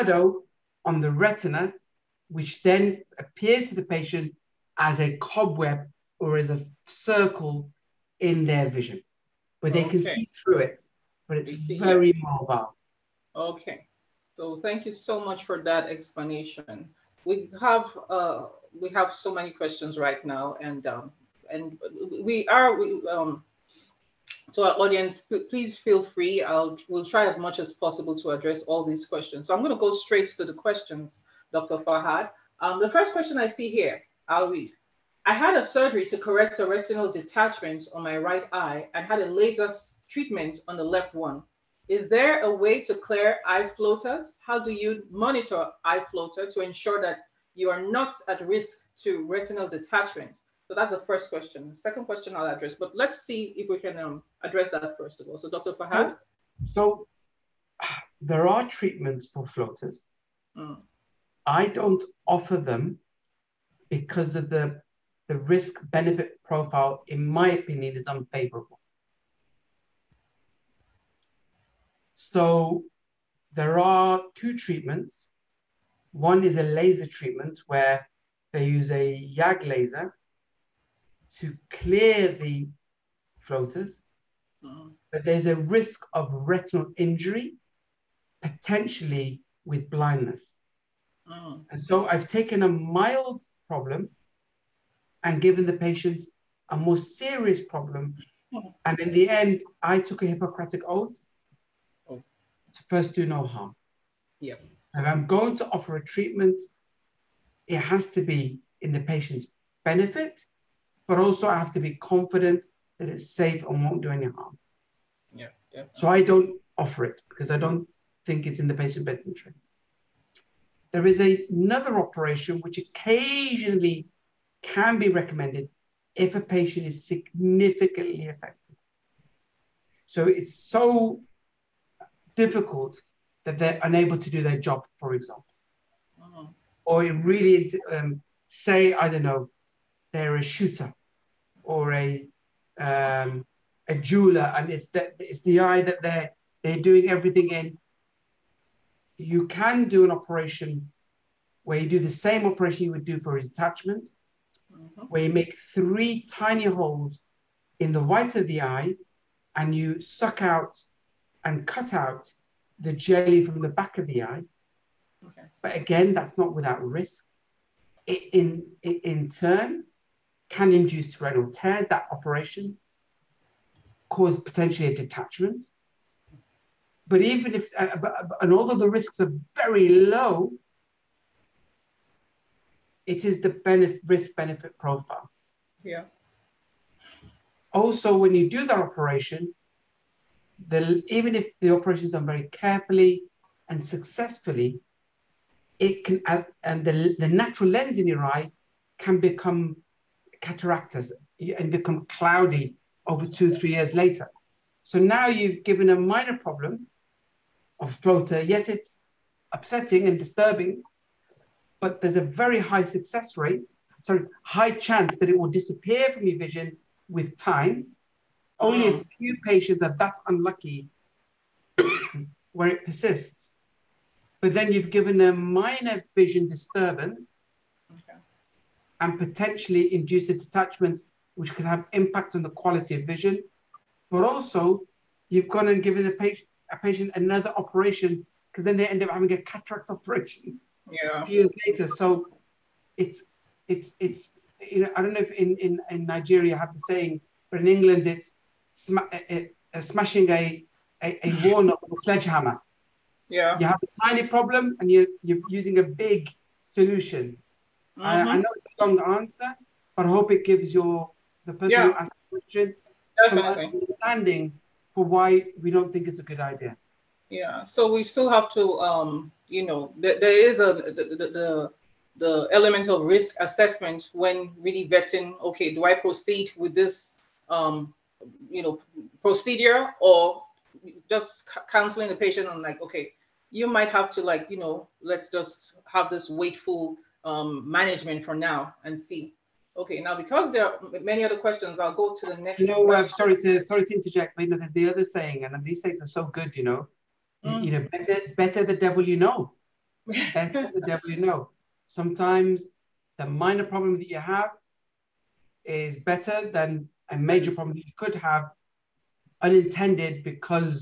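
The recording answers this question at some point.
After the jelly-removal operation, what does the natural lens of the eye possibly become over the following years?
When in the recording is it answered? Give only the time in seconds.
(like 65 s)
200 s.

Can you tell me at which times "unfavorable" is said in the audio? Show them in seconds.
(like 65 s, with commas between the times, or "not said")
68 s.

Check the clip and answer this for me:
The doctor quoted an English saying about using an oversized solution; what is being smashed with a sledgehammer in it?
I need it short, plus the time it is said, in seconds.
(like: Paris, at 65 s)
walnut, at 251 s.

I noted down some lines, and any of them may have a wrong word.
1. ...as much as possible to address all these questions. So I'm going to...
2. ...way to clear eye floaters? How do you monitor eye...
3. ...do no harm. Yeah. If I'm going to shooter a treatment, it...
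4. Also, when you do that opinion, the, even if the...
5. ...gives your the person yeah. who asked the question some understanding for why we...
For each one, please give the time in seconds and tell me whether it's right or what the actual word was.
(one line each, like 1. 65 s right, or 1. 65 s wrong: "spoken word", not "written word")
1. 27 s right
2. 42 s right
3. 103 s wrong: "offer", not "shooter"
4. 187 s wrong: "operation", not "opinion"
5. 260 s right.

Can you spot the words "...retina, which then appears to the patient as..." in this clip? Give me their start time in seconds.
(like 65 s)
1 s.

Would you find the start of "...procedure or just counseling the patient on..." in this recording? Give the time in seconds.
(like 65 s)
279 s.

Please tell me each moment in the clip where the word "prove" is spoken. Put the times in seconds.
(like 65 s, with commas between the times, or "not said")
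not said.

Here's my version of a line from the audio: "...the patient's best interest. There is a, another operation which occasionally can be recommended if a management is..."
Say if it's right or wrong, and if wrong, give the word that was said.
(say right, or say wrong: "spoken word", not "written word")
wrong: "patient", not "management".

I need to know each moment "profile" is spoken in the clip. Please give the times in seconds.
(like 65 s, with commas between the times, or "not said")
66 s, 184 s.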